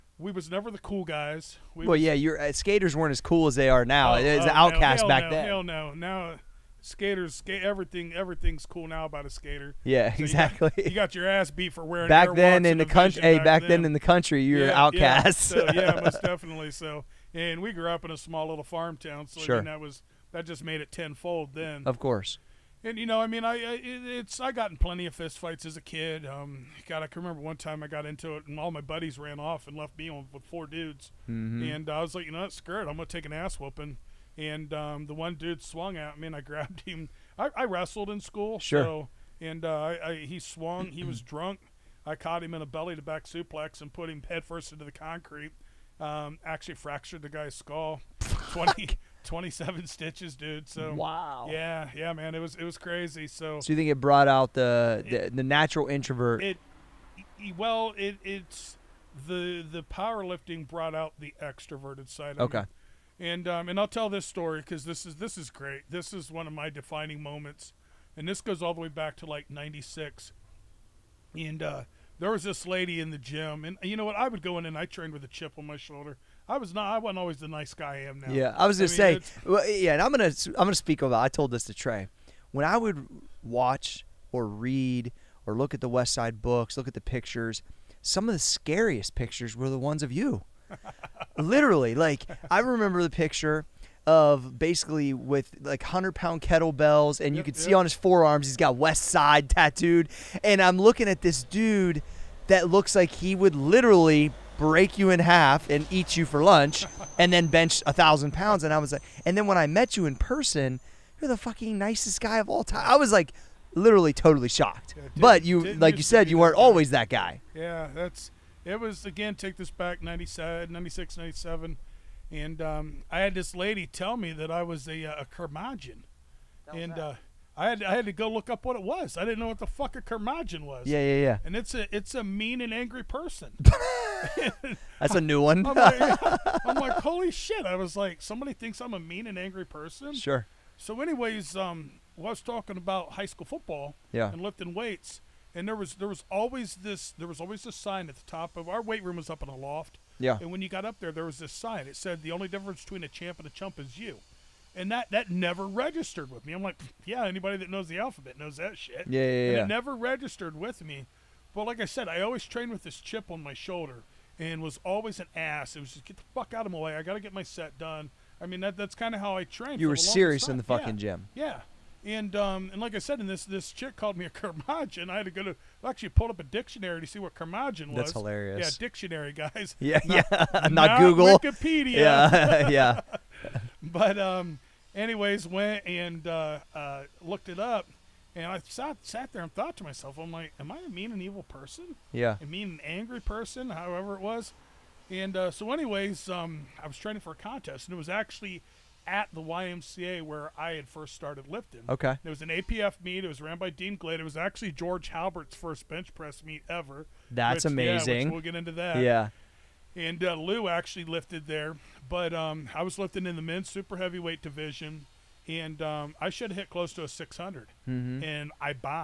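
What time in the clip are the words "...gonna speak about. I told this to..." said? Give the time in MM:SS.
01:20.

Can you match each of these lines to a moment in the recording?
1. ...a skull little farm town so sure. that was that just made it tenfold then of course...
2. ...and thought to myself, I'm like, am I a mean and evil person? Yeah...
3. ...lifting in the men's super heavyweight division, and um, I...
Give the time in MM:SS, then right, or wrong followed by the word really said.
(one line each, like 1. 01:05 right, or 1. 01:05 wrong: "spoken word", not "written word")
1. 00:18 wrong: "small", not "skull"
2. 03:09 right
3. 03:32 right.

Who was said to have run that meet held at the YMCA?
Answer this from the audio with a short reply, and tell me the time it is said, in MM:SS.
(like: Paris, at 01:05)
Dean Glade, at 03:23.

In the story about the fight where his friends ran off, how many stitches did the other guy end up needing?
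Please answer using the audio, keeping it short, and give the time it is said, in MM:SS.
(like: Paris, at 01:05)
27, at 00:49.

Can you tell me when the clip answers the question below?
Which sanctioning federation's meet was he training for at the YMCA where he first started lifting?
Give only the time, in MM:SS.
03:22.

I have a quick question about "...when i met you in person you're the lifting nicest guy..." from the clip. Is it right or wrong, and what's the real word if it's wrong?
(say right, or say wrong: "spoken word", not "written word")
wrong: "fucking", not "lifting".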